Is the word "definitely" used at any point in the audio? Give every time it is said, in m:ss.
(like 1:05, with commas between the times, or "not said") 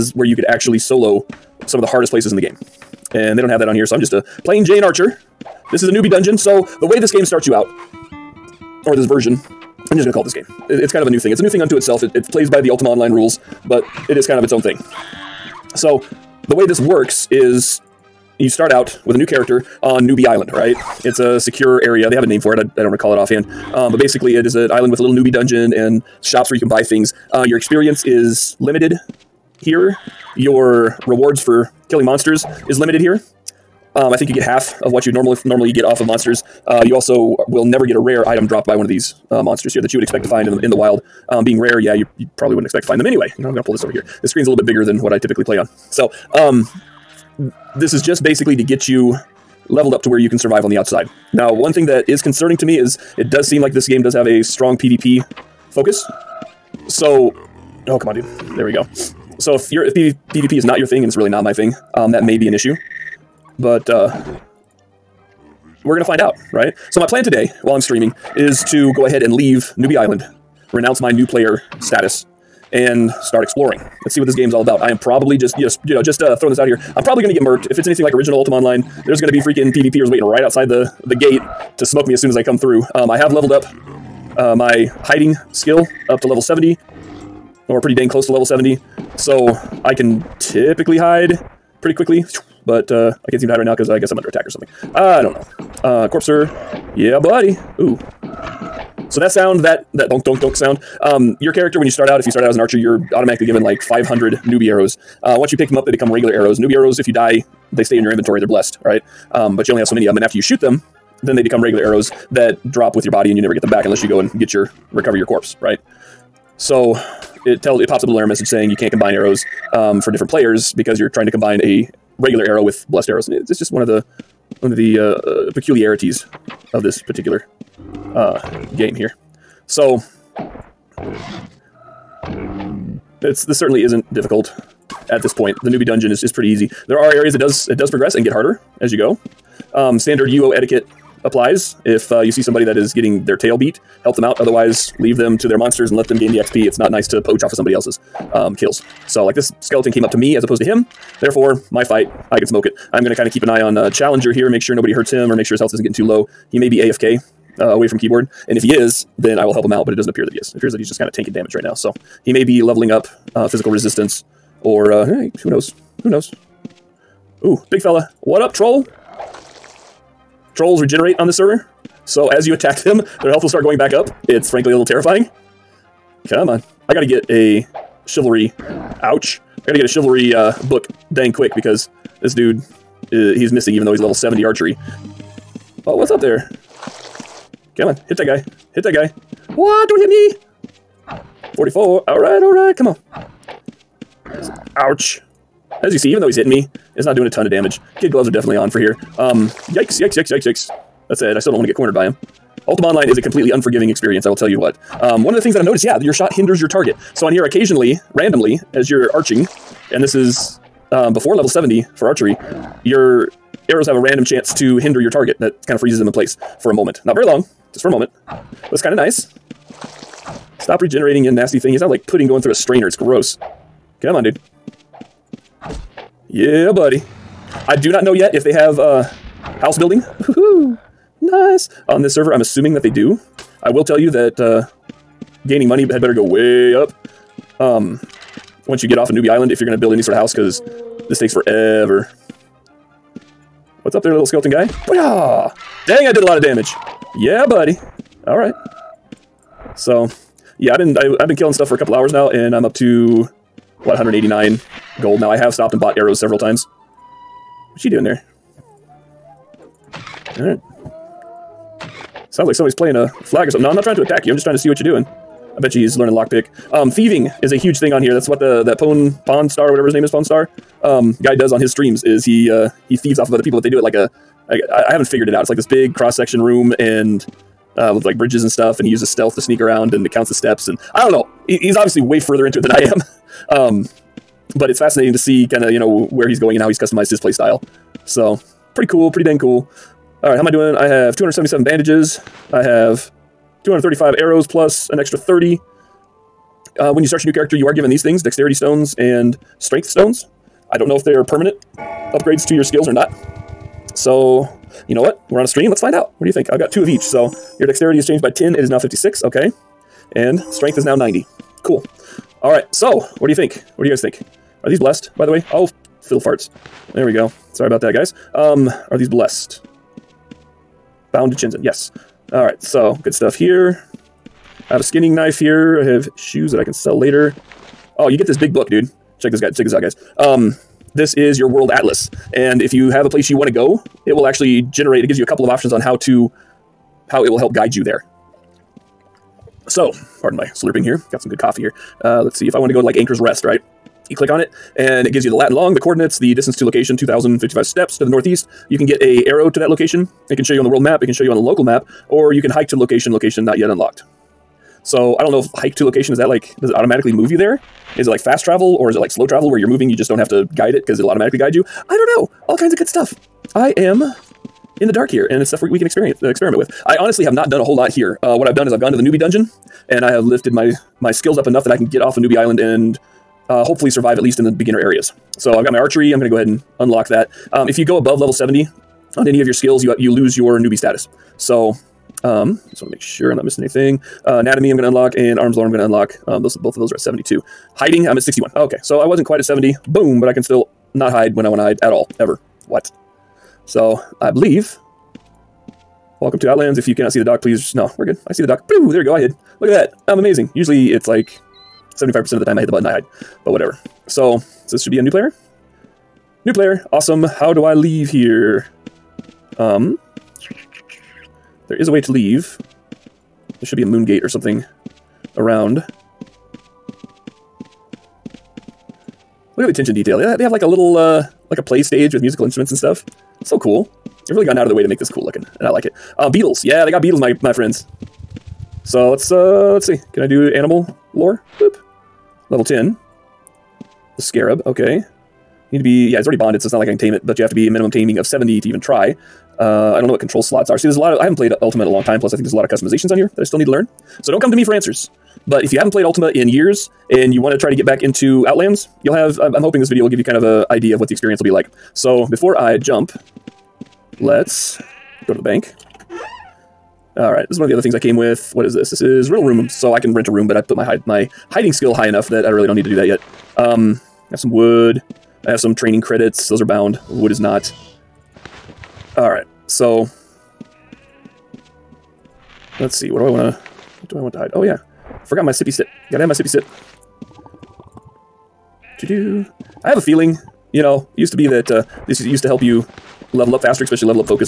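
3:18.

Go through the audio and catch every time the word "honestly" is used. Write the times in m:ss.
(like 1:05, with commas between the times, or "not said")
6:06.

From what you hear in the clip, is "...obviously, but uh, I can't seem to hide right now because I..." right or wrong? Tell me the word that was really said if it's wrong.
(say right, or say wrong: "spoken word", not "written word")
wrong: "quickly", not "obviously".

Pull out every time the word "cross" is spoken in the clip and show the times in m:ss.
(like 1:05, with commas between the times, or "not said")
4:35.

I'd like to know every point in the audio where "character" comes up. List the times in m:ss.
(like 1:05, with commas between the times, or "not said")
0:19, 1:41, 4:57.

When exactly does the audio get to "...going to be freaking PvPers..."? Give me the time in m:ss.
1:19.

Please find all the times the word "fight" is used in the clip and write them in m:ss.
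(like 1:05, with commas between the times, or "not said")
2:31.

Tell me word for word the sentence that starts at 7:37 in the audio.
All right, this is one of the other things I came with.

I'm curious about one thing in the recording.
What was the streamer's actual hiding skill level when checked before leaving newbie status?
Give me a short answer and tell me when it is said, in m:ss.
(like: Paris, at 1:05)
61, at 6:27.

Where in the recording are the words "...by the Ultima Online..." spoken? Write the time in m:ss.
0:12.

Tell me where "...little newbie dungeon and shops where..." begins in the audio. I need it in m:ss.
0:25.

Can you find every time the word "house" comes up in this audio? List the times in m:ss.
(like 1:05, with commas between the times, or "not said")
3:49, 4:00.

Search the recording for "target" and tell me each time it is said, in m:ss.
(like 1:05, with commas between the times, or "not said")
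3:26, 3:35.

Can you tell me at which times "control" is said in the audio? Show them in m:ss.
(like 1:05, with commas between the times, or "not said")
7:20.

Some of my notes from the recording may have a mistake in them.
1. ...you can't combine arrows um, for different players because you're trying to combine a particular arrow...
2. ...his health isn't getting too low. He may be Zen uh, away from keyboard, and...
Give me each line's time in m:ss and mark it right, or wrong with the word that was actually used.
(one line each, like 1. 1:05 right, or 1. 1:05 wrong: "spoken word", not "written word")
1. 1:58 wrong: "regular", not "particular"
2. 2:35 wrong: "AFK", not "Zen".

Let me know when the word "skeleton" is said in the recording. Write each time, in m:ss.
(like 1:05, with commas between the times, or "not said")
2:29, 4:04.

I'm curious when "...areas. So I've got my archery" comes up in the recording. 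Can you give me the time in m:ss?
6:14.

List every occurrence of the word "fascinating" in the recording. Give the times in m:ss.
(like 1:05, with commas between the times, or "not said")
4:44.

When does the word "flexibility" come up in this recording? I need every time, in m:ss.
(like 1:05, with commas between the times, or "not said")
not said.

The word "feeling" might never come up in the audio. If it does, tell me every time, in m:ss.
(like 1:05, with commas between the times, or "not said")
7:59.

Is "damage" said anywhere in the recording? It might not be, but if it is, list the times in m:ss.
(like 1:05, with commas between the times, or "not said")
2:41, 3:17, 4:06.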